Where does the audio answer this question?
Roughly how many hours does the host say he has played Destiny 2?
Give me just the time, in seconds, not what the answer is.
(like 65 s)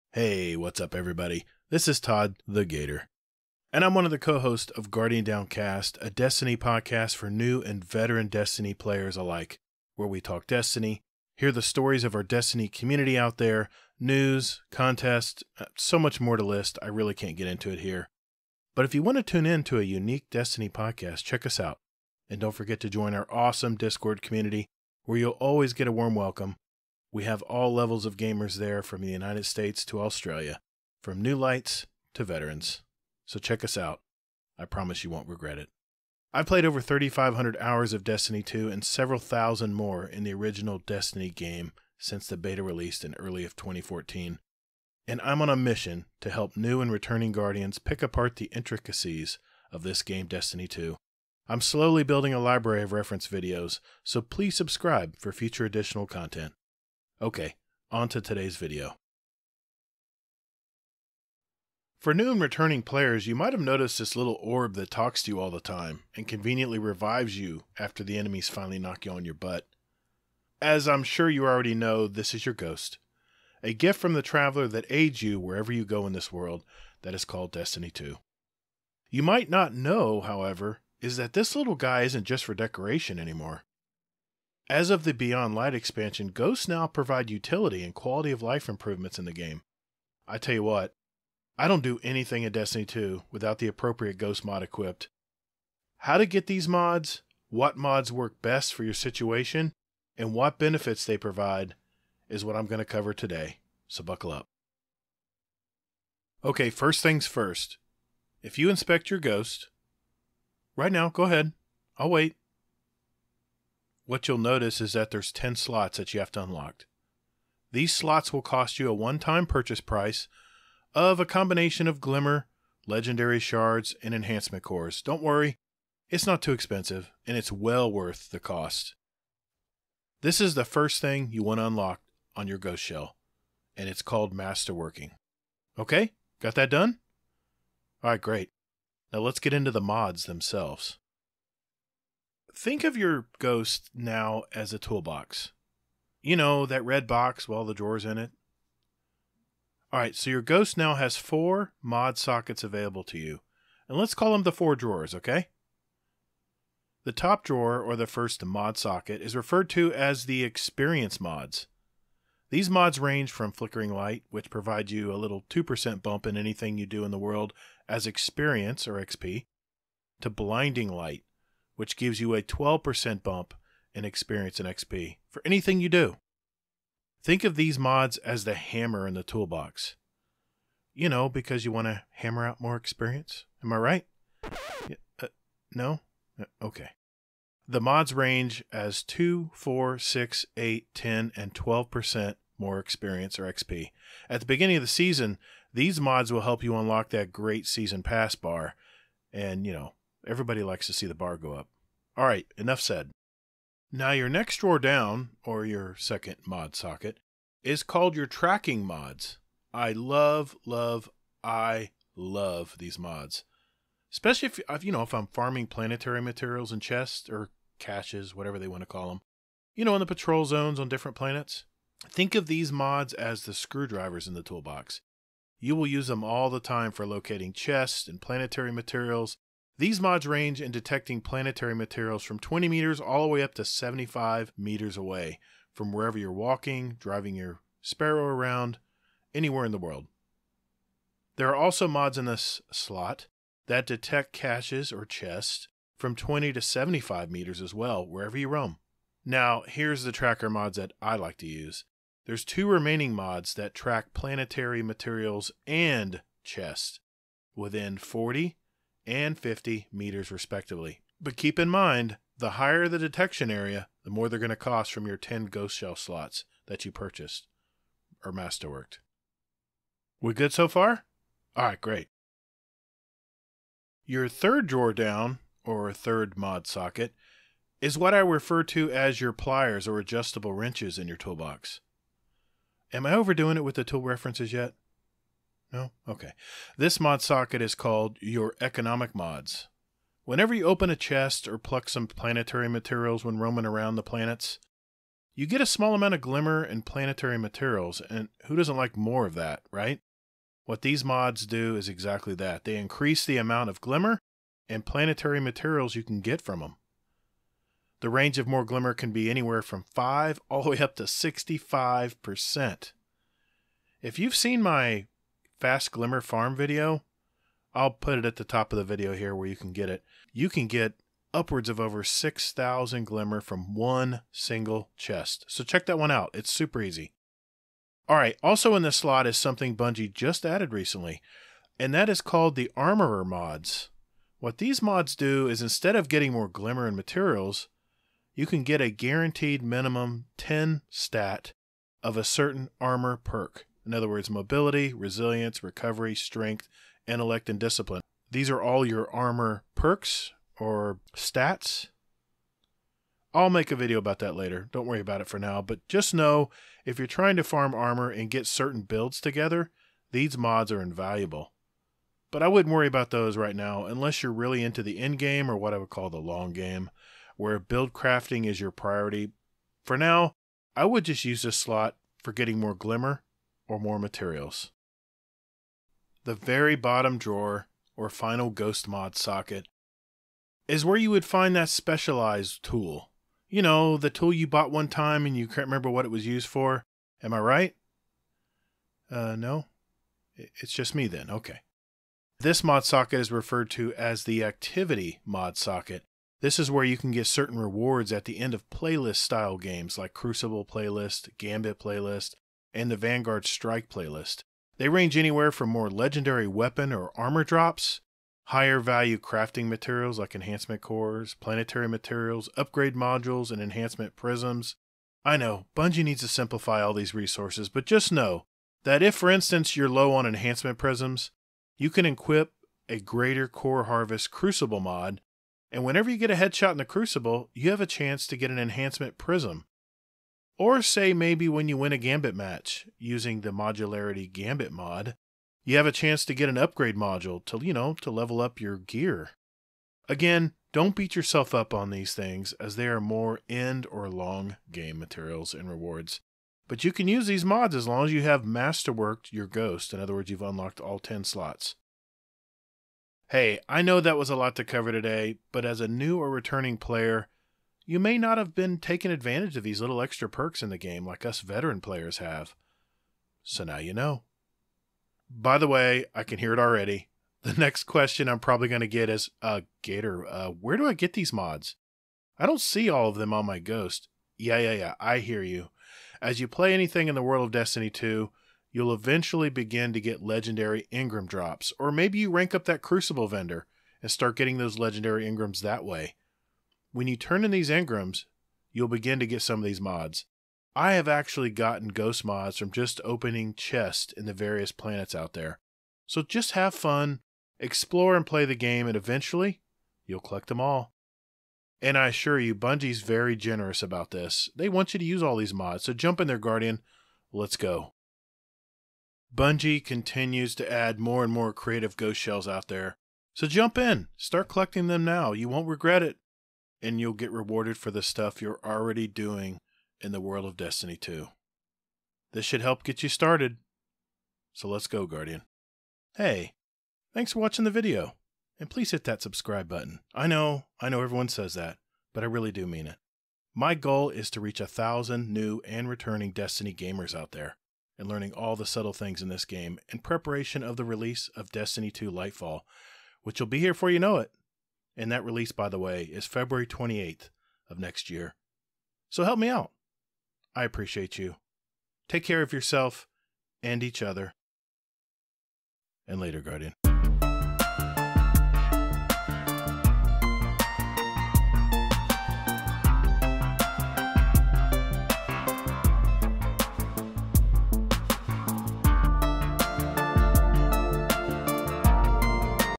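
36 s.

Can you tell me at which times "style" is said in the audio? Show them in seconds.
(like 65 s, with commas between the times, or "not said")
399 s.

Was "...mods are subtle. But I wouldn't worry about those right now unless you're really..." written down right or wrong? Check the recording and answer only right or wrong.
wrong.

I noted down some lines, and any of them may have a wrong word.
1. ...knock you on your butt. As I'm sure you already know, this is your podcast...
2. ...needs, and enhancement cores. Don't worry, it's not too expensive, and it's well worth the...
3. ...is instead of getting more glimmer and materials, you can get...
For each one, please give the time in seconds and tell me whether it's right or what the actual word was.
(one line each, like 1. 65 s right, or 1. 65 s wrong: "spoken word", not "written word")
1. 68 s wrong: "ghost", not "podcast"
2. 123 s wrong: "shards", not "needs"
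3. 335 s right.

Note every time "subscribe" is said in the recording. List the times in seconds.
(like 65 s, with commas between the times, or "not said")
54 s, 529 s.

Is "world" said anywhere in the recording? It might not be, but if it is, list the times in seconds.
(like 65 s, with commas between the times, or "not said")
76 s, 167 s, 239 s, 477 s, 520 s.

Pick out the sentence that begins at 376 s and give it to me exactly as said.
The very bottom drawer, or final ghost mod socket, is where you would find that specialized tool.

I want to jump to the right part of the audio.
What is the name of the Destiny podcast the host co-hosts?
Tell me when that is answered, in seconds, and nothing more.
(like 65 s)
4 s.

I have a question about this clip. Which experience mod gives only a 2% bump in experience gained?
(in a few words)
Flickering Light.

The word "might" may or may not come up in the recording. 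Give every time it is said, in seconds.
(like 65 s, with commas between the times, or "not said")
63 s, 79 s.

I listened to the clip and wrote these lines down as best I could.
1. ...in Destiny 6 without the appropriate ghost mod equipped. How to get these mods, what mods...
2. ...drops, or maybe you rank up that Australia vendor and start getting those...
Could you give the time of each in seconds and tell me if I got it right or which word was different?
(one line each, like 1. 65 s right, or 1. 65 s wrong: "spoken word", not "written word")
1. 92 s wrong: "2", not "6"
2. 481 s wrong: "Crucible", not "Australia".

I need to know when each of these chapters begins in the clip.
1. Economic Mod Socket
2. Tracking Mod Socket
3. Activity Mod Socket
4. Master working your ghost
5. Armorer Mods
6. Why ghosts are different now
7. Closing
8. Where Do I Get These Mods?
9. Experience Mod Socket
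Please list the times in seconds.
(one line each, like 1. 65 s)
1. 274 s
2. 204 s
3. 376 s
4. 105 s
5. 328 s
6. 61 s
7. 526 s
8. 465 s
9. 157 s.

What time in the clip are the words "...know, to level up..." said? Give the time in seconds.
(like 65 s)
437 s.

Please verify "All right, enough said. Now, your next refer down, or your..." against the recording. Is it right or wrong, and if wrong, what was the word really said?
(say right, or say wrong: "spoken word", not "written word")
wrong: "drawer", not "refer".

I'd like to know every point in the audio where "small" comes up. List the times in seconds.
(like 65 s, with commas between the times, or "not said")
295 s.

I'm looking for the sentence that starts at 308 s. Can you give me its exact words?
The range of more glimmer can be anywhere from 5 all the way up to 65%.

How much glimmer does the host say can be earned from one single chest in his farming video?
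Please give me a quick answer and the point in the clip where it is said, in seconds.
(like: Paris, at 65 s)
over 6,000, at 321 s.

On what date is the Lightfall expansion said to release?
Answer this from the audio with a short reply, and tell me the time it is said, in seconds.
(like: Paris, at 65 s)
February 28th, at 546 s.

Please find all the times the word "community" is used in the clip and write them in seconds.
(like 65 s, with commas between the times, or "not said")
12 s, 24 s.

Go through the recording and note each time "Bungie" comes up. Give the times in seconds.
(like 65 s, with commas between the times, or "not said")
329 s, 415 s, 502 s, 509 s.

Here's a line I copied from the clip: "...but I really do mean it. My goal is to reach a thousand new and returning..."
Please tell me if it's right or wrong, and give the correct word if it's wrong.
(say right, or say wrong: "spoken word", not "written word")
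right.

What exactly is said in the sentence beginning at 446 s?
But you can use these mods as long as you have masterworked your ghost.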